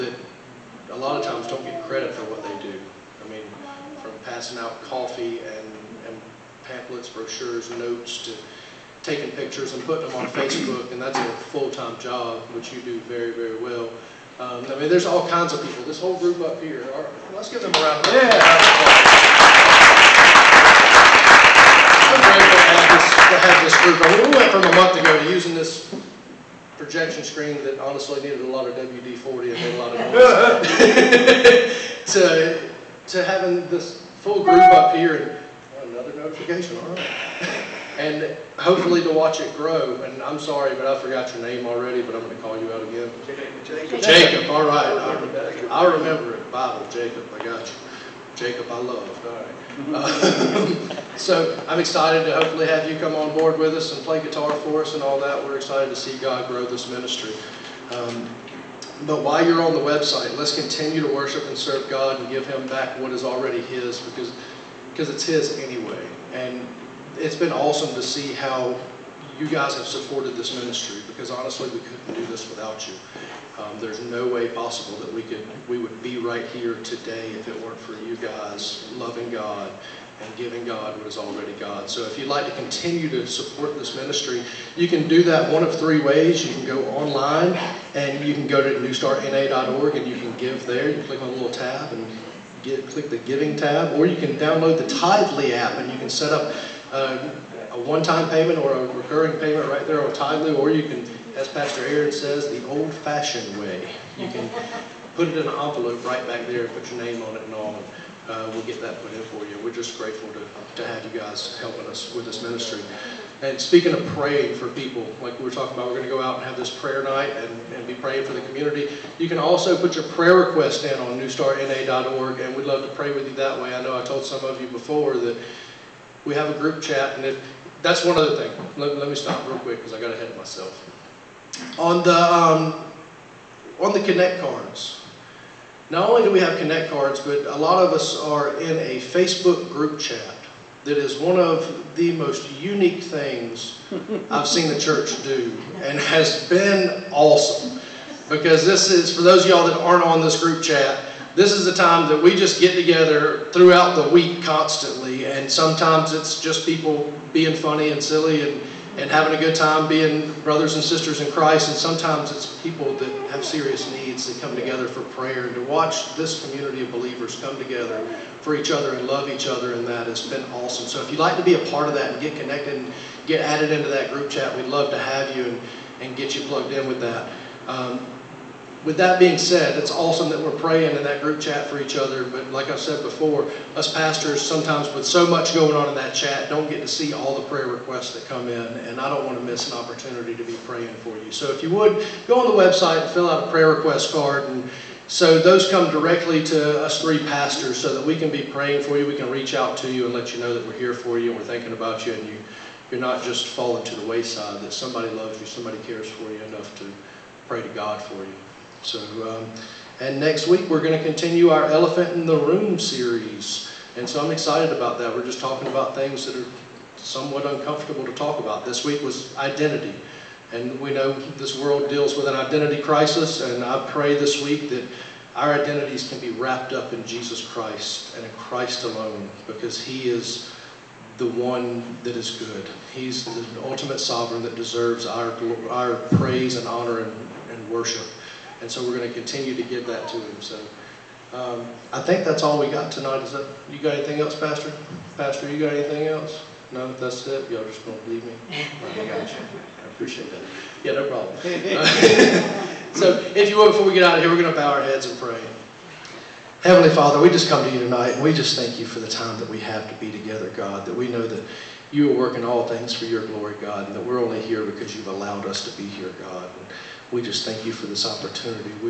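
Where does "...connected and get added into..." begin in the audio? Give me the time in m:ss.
2:52.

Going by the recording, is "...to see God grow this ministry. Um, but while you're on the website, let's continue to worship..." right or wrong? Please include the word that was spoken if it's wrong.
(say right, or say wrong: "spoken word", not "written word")
right.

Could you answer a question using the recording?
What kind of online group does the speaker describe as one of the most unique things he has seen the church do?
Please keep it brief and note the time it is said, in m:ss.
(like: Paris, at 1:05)
Facebook group chat, at 2:18.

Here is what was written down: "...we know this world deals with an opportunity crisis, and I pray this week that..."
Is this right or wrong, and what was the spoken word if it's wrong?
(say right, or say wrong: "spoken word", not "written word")
wrong: "identity", not "opportunity".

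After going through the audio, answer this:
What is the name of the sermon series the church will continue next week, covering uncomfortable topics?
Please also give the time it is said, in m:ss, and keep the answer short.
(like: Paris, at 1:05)
Elephant in the Room, at 3:31.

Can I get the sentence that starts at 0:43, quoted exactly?
Jacob, Jacob all remember I'll, remember it.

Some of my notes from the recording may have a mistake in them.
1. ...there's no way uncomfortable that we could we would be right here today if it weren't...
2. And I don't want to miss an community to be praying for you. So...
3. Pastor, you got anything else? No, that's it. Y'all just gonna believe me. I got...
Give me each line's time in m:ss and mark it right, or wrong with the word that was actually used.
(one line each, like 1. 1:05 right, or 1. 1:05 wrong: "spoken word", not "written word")
1. 1:13 wrong: "possible", not "uncomfortable"
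2. 3:08 wrong: "opportunity", not "community"
3. 4:05 right.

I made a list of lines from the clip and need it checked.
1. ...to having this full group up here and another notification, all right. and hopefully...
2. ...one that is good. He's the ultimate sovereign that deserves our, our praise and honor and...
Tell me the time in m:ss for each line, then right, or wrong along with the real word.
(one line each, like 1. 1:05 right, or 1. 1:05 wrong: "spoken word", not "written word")
1. 0:33 right
2. 3:51 right.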